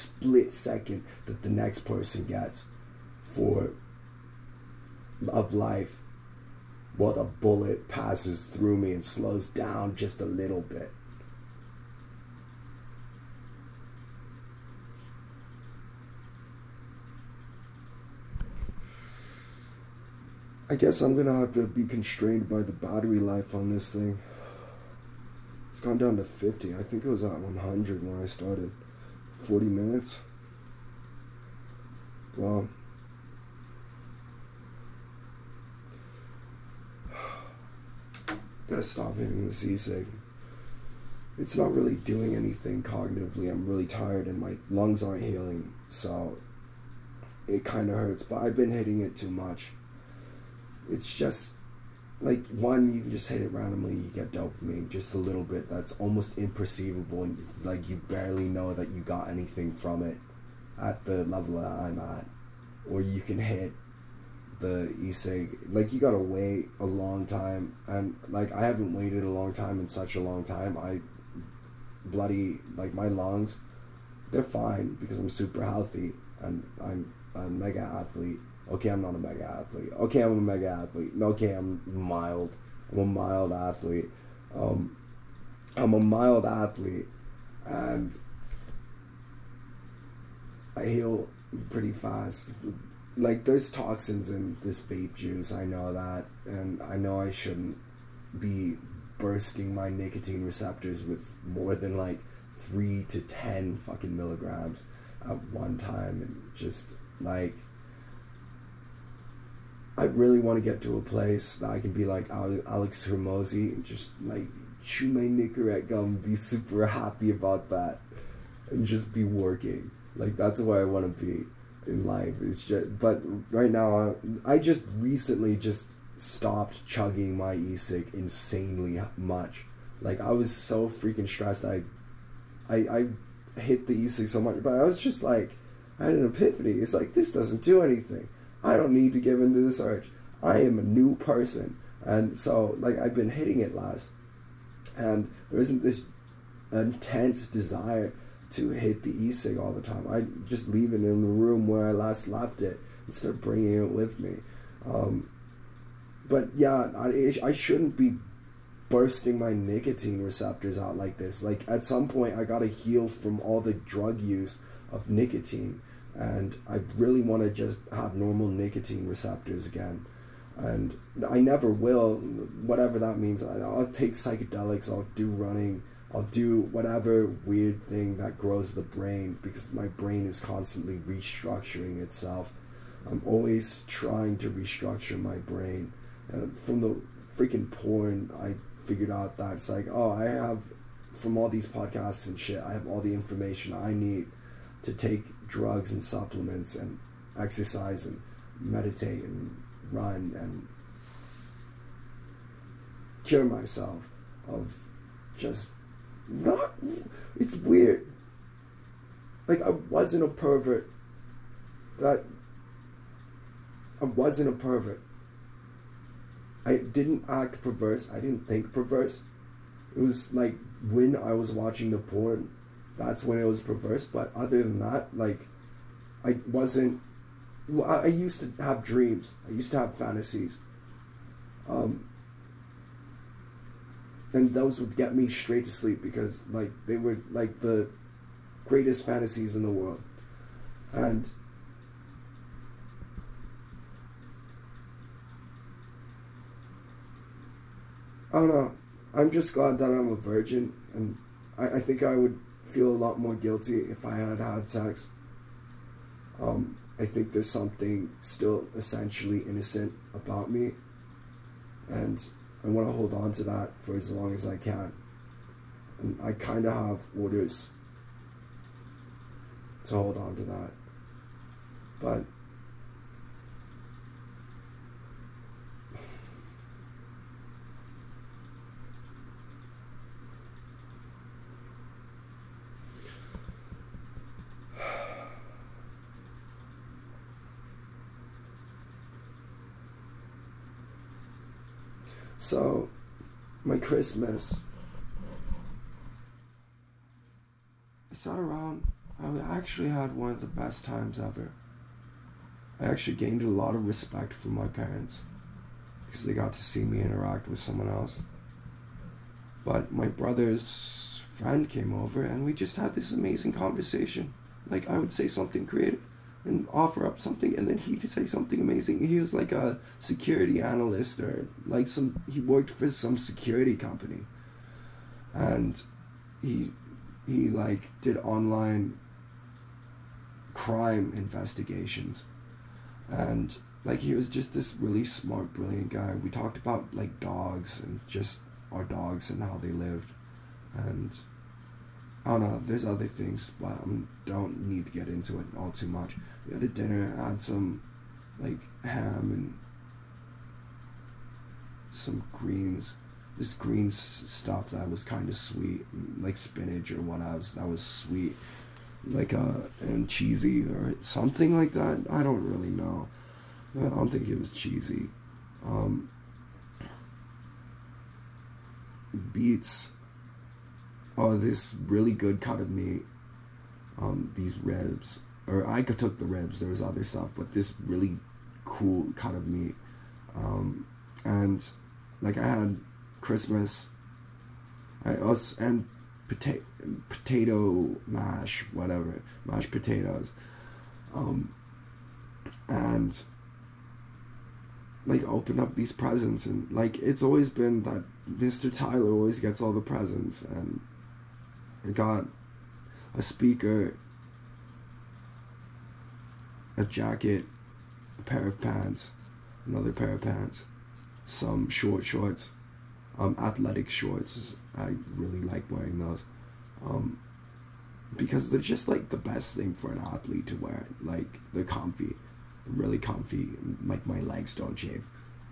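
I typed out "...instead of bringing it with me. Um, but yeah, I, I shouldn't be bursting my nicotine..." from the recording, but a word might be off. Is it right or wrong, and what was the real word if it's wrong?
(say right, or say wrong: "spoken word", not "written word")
right.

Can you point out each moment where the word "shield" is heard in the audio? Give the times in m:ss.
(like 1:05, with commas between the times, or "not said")
not said.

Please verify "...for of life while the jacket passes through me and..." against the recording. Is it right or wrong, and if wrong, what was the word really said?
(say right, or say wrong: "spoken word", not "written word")
wrong: "bullet", not "jacket".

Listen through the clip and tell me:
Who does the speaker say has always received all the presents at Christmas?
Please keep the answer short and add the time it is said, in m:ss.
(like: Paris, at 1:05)
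Mr. Tyler, at 6:38.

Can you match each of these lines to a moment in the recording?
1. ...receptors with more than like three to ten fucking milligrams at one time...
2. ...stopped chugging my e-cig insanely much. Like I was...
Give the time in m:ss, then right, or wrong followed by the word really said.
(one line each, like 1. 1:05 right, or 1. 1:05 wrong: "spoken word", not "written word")
1. 1:40 right
2. 2:06 right.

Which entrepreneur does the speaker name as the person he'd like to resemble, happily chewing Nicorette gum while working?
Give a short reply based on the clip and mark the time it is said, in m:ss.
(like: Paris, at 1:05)
Alex Hormozi, at 1:52.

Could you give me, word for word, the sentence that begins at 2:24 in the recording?
And there isn't this intense desire to hit the e cig all the time.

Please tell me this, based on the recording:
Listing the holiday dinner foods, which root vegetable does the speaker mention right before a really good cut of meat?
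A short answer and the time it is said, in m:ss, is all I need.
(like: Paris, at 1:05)
Beets, at 6:09.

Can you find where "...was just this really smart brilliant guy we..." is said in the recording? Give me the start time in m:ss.
5:34.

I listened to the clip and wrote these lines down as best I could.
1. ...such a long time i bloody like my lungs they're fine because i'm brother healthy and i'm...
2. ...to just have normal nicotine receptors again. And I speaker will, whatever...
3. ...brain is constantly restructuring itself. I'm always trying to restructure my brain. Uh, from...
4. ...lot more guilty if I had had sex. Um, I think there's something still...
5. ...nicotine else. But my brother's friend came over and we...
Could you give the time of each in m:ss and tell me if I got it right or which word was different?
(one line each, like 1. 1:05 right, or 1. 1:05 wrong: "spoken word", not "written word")
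1. 1:09 wrong: "super", not "brother"
2. 2:47 wrong: "never", not "speaker"
3. 2:59 right
4. 4:13 right
5. 5:07 wrong: "someone", not "nicotine".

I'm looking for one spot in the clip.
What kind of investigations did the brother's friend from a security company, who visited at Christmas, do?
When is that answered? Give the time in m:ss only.
5:28.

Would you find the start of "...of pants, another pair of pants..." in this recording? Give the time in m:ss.
6:48.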